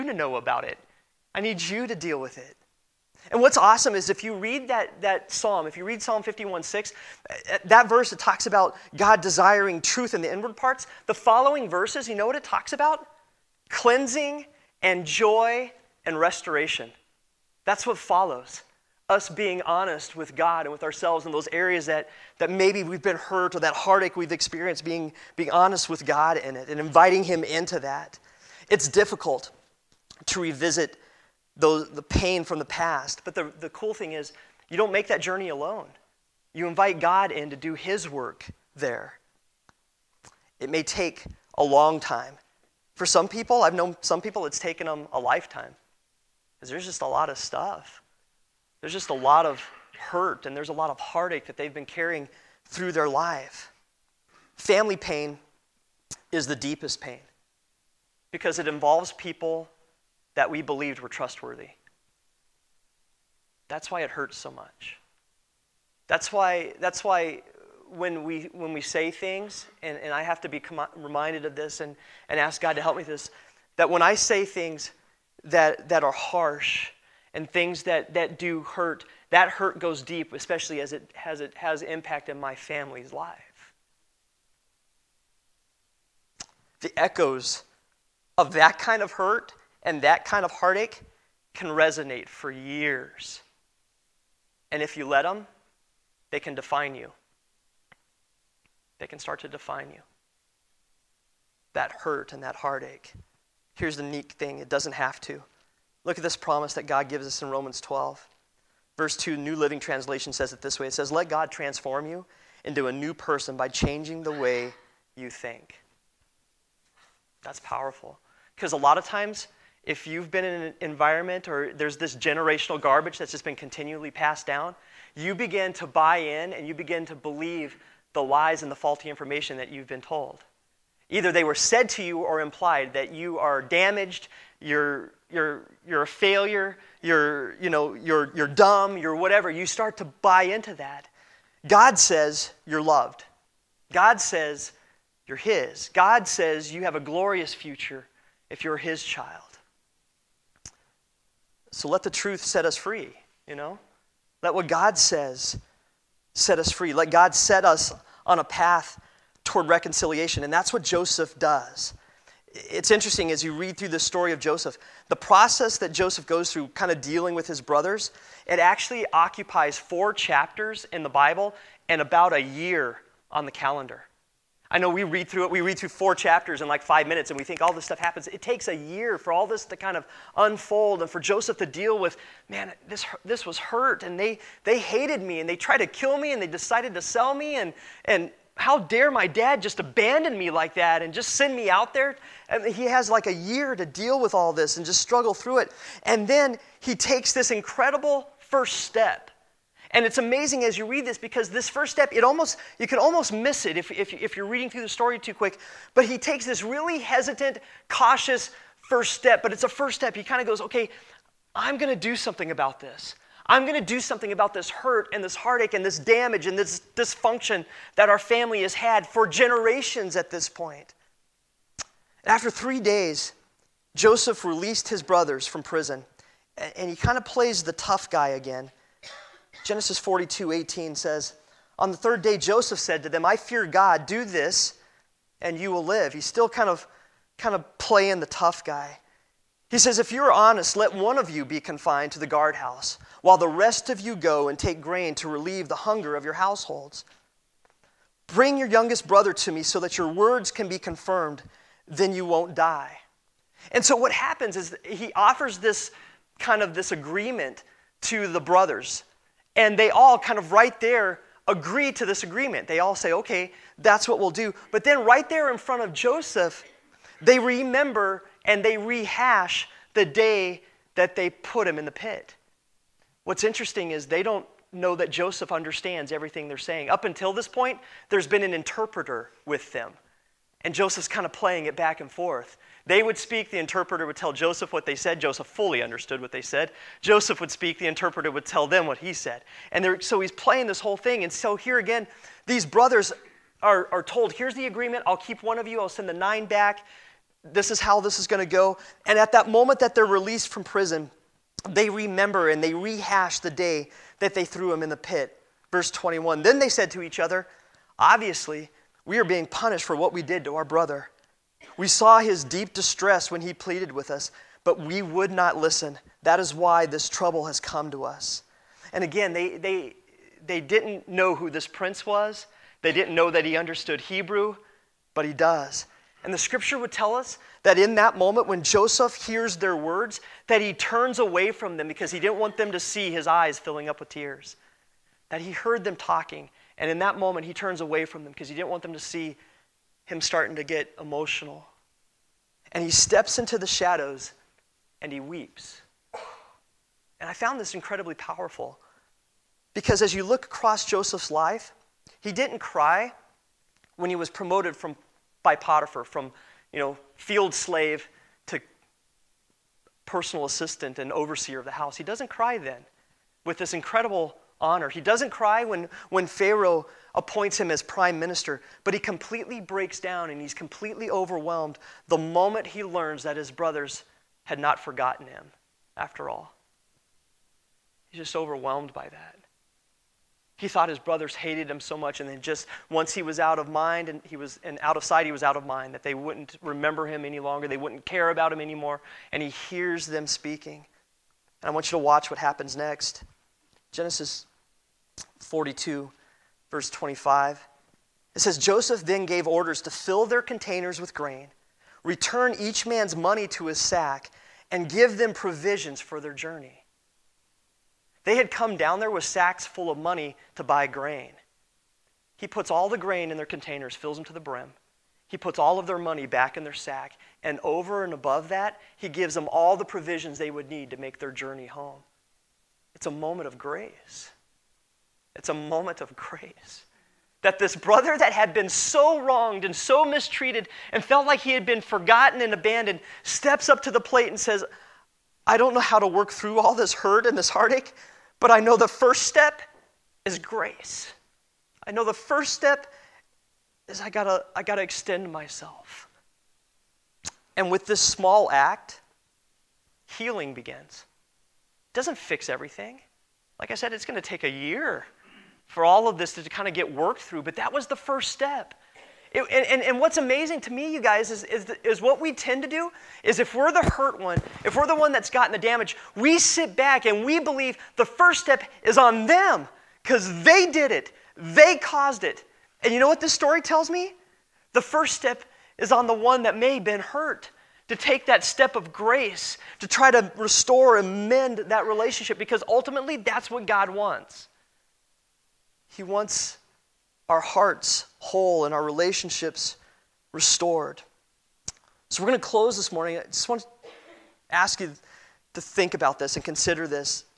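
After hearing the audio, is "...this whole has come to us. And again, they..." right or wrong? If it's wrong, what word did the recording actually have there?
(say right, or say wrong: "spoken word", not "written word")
wrong: "trouble", not "whole".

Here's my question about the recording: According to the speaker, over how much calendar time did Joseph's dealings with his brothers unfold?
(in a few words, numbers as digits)
About a year.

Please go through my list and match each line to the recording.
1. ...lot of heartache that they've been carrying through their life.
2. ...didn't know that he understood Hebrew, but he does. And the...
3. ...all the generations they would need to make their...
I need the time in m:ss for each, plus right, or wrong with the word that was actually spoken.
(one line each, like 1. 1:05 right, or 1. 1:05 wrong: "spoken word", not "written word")
1. 0:50 right
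2. 5:22 right
3. 6:59 wrong: "provisions", not "generations".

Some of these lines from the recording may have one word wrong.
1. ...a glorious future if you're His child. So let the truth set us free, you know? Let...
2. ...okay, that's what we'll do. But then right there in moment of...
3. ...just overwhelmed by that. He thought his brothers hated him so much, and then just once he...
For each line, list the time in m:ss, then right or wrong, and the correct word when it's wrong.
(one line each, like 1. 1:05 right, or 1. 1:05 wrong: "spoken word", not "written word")
1. 2:26 right
2. 4:23 wrong: "front", not "moment"
3. 6:18 right.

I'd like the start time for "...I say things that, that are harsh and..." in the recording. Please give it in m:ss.
1:14.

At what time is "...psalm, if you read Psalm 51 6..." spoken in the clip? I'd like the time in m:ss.
0:05.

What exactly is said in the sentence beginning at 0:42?
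For some people, I've known some people it's taken them a lifetime Cause there's just a lot of stuff.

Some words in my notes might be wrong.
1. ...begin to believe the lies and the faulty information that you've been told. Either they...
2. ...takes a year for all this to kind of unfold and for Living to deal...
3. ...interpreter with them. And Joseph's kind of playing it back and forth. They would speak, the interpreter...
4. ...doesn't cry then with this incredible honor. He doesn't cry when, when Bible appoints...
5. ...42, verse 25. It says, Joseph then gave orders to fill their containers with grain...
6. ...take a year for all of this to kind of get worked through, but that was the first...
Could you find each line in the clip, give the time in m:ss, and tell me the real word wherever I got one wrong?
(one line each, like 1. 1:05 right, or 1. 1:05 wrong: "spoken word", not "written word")
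1. 2:06 right
2. 2:58 wrong: "Joseph", not "Living"
3. 4:38 right
4. 6:02 wrong: "Pharaoh", not "Bible"
5. 6:35 right
6. 7:34 right.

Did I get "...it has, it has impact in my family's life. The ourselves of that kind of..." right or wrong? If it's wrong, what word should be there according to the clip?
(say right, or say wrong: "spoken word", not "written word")
wrong: "echoes", not "ourselves".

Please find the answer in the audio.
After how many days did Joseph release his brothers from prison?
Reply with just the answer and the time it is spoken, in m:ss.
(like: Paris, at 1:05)
3, at 3:42.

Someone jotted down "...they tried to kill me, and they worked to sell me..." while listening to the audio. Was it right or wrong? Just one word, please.
wrong.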